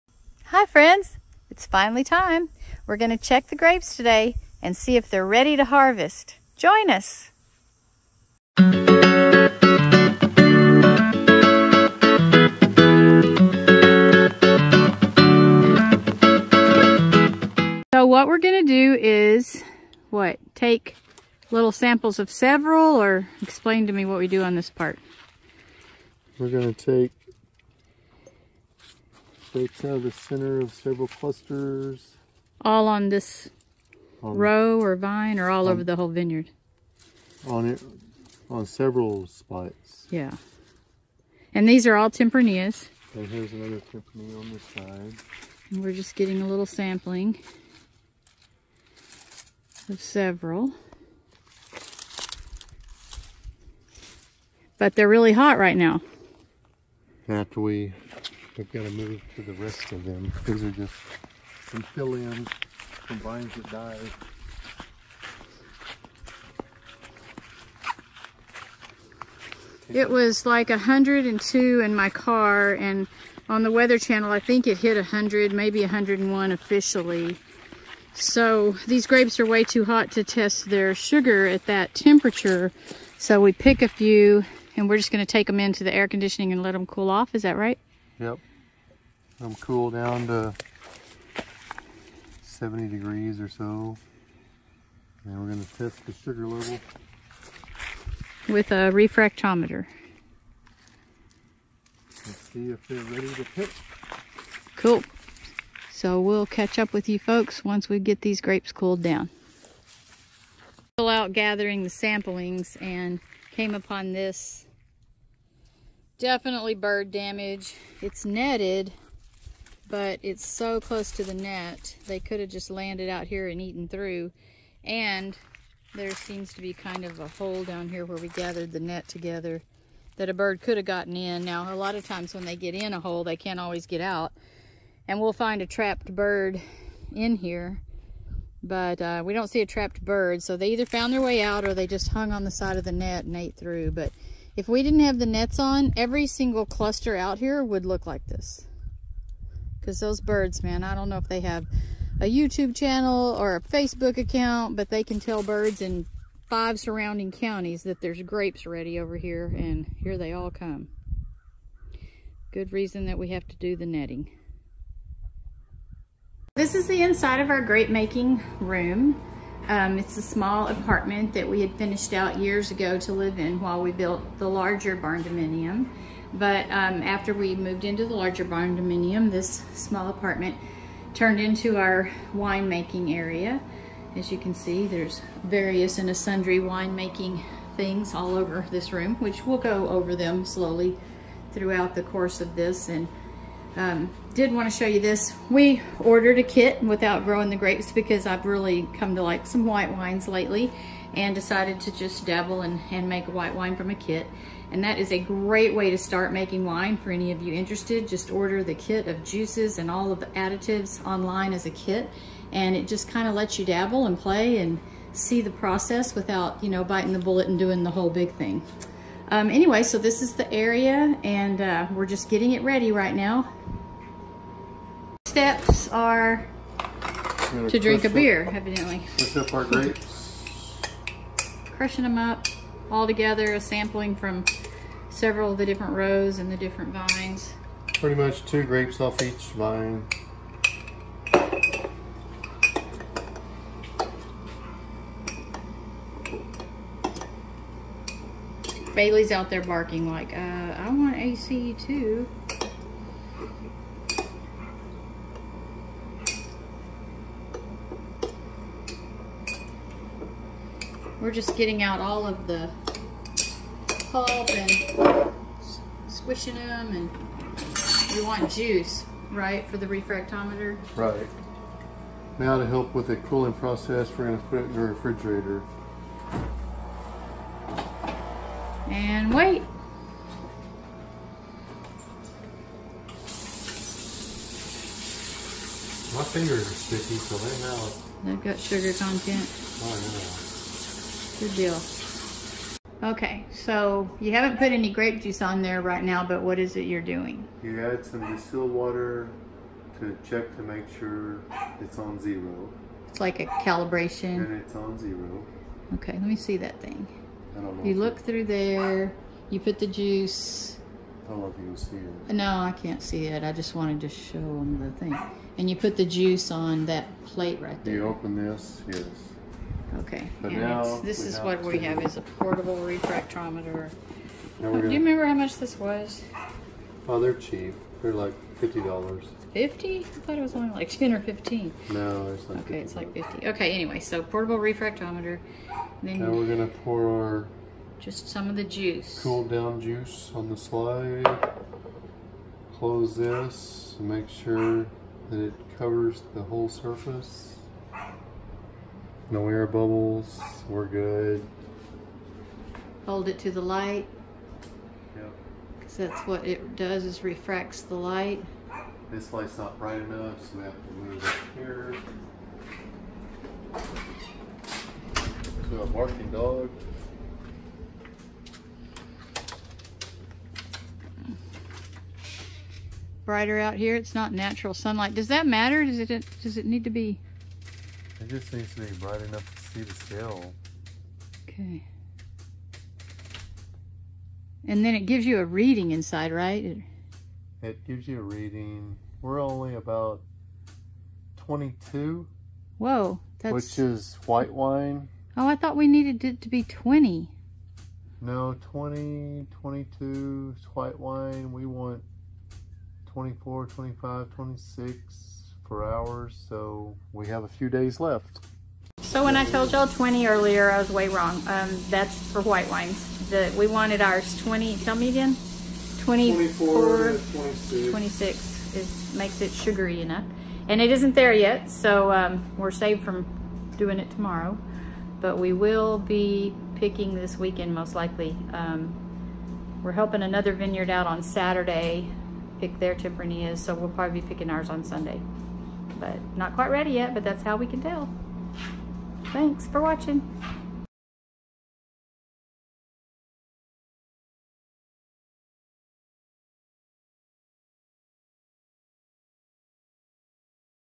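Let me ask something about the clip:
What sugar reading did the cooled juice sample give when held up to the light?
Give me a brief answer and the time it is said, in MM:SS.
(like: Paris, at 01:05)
22, at 06:29.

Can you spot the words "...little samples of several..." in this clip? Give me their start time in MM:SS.
00:21.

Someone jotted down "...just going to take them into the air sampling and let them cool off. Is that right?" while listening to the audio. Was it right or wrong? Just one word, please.
wrong.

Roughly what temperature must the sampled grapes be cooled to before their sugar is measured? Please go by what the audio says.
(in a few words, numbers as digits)
70 degrees.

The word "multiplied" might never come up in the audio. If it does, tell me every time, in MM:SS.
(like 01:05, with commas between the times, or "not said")
not said.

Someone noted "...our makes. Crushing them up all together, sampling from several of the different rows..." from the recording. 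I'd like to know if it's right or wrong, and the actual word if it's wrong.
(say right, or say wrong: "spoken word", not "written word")
wrong: "grapes", not "makes".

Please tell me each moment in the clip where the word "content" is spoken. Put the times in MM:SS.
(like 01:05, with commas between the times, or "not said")
04:48.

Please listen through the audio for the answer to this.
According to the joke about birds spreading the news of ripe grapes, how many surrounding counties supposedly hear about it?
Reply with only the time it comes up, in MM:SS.
02:36.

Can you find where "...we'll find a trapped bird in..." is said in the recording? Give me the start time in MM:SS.
02:15.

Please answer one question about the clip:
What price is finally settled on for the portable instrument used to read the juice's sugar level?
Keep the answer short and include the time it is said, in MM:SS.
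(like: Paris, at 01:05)
$50, at 05:33.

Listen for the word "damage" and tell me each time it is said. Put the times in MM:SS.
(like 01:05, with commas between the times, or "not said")
01:57.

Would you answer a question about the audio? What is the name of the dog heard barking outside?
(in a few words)
Bailey.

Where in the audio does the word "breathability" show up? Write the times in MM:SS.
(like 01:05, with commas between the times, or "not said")
not said.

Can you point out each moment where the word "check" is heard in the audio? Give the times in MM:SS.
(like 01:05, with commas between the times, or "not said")
00:03, 05:00.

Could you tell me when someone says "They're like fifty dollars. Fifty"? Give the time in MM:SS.
05:28.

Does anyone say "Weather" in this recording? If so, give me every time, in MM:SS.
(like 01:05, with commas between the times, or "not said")
01:13.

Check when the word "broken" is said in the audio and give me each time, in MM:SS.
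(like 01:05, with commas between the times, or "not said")
not said.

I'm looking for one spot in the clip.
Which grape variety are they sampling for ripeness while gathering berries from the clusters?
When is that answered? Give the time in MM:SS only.
00:41.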